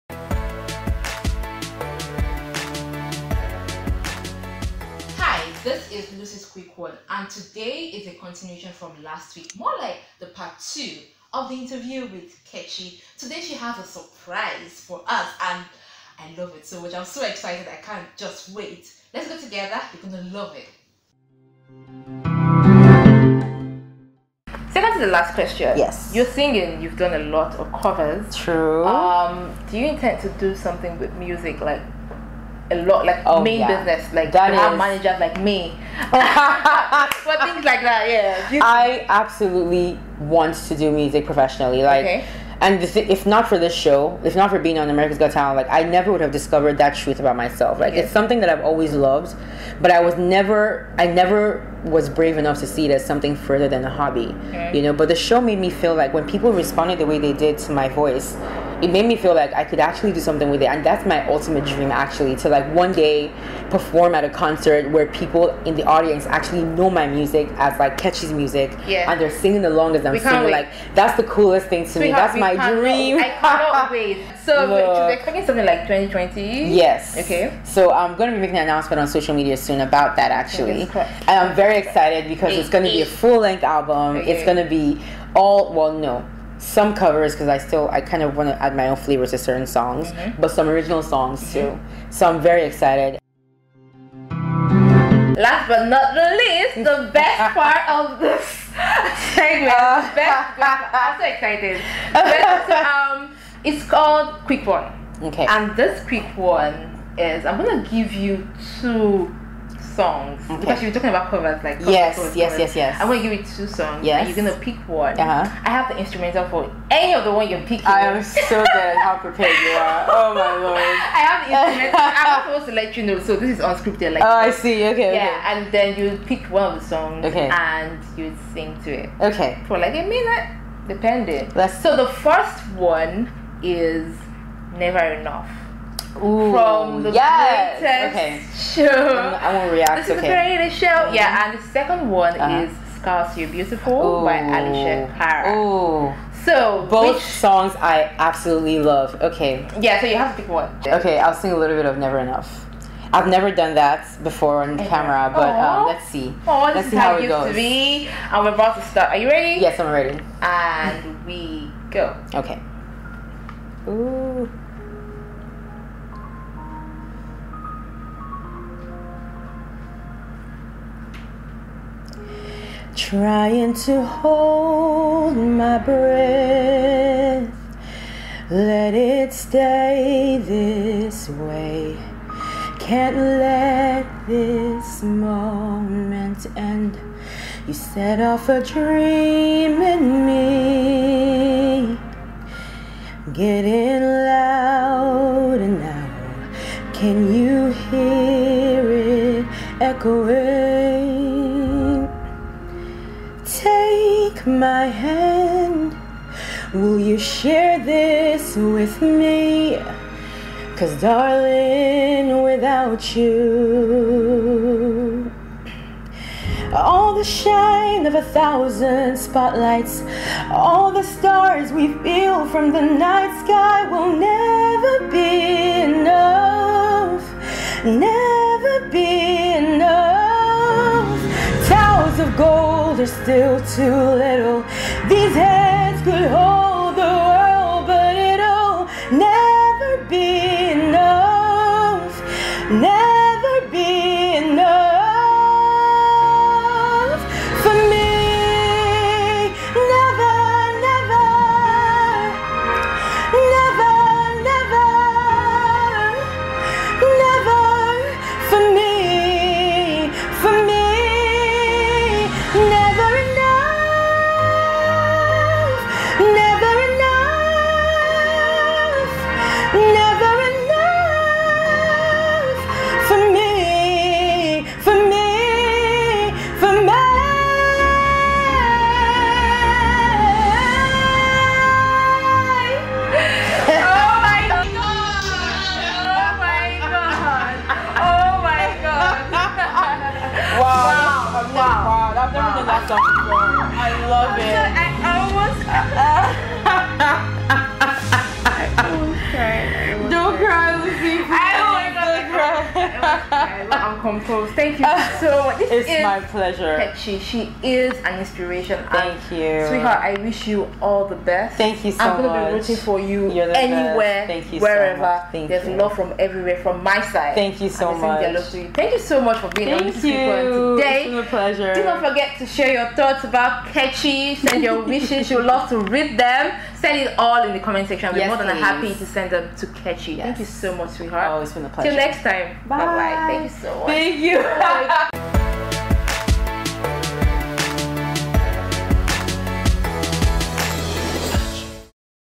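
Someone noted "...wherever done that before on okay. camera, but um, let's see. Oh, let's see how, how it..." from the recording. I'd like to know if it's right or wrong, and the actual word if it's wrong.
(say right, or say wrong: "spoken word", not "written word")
wrong: "never", not "wherever".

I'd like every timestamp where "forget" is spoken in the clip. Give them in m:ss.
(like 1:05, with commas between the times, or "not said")
5:22.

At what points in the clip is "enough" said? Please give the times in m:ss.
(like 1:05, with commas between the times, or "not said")
0:52, 2:15, 2:32.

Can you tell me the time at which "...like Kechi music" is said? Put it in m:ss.
1:07.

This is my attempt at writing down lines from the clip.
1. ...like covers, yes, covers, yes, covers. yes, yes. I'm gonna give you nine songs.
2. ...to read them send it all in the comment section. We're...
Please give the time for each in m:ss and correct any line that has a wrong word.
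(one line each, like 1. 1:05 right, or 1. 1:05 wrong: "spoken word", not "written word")
1. 1:51 wrong: "two", not "nine"
2. 5:25 right.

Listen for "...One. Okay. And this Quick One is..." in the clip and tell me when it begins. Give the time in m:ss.
1:44.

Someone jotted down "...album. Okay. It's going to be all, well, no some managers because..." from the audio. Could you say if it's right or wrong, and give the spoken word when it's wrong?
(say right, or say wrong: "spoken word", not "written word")
wrong: "covers", not "managers".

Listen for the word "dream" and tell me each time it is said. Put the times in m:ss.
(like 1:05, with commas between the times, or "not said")
1:01, 1:12, 3:08.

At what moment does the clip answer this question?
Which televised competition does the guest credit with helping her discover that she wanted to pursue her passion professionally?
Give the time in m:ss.
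0:44.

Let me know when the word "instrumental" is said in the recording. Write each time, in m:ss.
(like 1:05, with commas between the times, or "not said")
1:55, 2:01.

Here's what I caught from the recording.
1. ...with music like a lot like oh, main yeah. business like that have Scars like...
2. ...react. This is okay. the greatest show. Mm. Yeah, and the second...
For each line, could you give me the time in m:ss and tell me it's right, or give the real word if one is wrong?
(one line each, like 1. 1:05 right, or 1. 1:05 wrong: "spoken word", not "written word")
1. 0:30 wrong: "managers", not "Scars"
2. 2:19 right.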